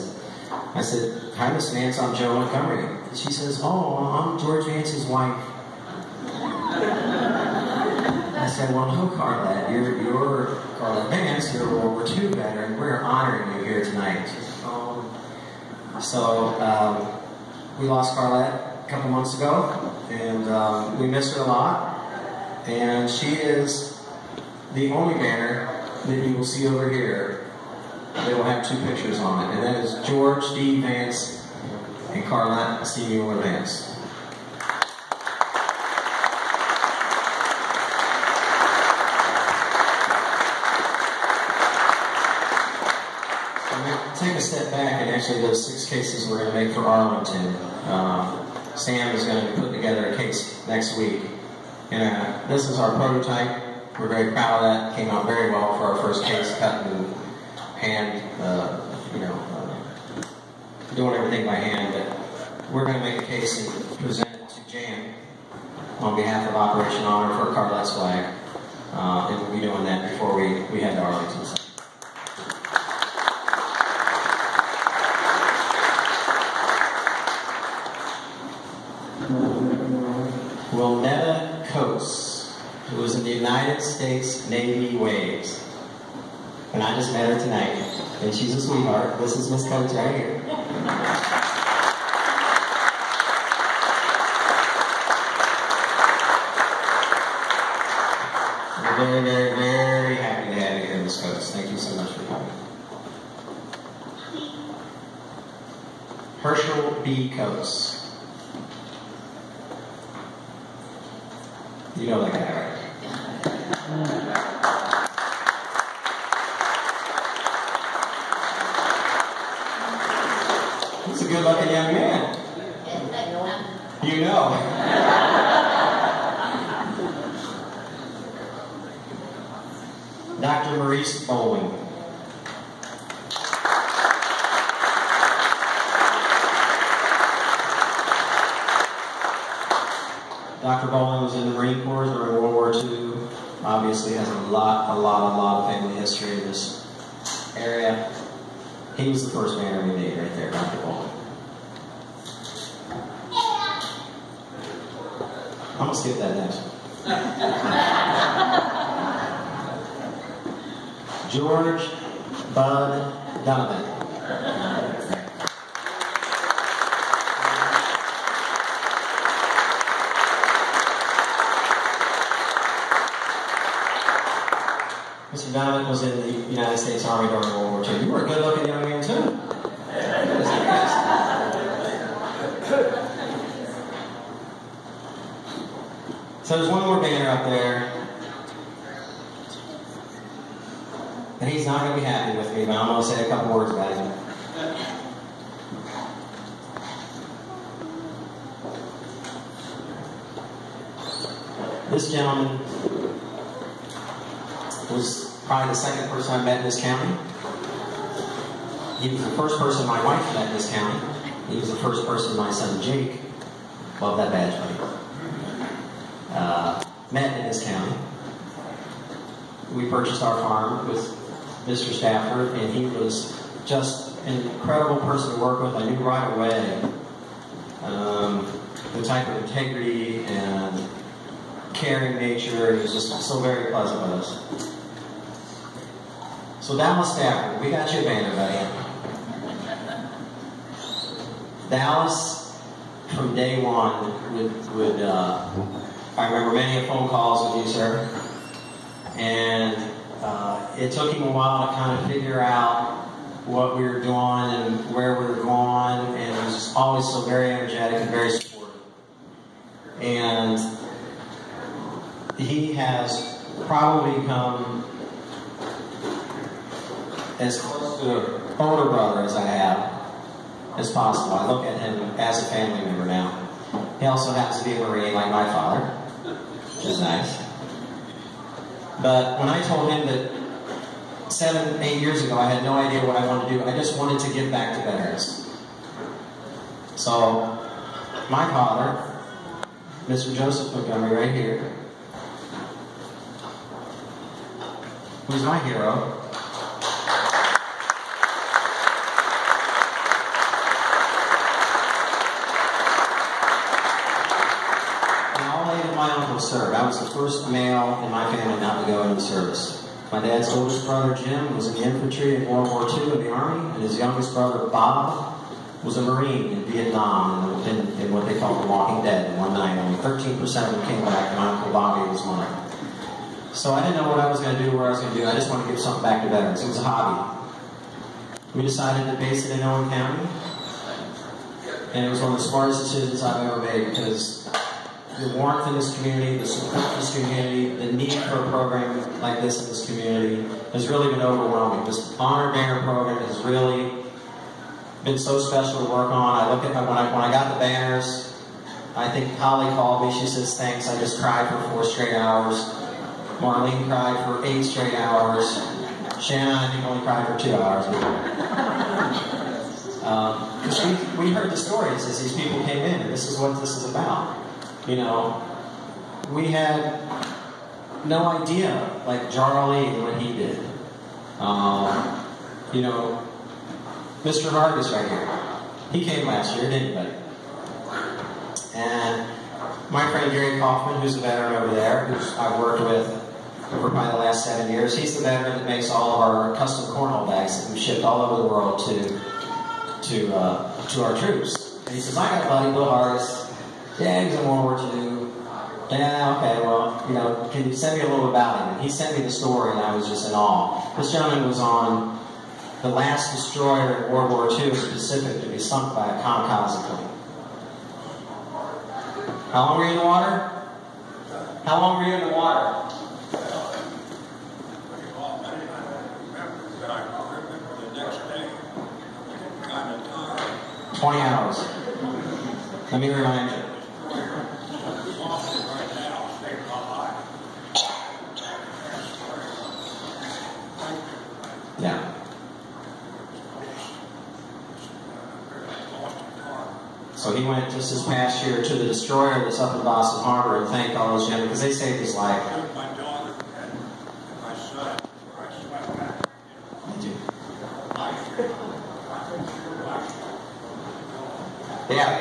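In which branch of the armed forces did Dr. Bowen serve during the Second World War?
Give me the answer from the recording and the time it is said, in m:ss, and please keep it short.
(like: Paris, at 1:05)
Marine Corps, at 2:21.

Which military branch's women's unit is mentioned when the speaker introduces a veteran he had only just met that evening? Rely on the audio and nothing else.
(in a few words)
Navy WAVES.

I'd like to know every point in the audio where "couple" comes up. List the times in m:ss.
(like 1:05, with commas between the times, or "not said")
0:18, 3:13.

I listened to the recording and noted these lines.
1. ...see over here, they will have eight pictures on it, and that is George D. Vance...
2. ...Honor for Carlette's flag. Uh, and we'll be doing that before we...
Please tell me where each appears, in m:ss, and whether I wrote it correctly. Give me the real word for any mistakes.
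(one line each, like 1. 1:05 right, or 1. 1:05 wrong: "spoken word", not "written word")
1. 0:26 wrong: "two", not "eight"
2. 1:07 right.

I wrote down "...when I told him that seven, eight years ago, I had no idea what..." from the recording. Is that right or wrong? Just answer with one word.
right.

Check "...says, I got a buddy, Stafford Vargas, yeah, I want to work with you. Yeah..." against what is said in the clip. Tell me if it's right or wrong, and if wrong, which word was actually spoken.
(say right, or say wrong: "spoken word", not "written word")
wrong: "Bill", not "Stafford".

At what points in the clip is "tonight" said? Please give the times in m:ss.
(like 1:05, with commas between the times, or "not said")
0:13, 1:27.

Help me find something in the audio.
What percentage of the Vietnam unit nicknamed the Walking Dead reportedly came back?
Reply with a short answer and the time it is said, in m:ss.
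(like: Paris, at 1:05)
13%, at 5:19.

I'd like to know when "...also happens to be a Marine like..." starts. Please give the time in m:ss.
4:34.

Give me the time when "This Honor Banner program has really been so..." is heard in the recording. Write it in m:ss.
5:41.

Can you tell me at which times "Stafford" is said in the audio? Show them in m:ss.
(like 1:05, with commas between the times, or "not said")
3:41, 3:57.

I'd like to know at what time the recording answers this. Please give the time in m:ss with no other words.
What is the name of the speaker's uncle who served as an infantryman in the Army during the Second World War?
5:11.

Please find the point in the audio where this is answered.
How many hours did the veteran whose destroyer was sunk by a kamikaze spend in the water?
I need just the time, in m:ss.
7:00.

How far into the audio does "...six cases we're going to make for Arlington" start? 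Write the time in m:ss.
0:45.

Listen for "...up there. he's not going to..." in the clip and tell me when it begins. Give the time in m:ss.
3:07.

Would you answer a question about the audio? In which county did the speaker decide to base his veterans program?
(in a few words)
Owen County.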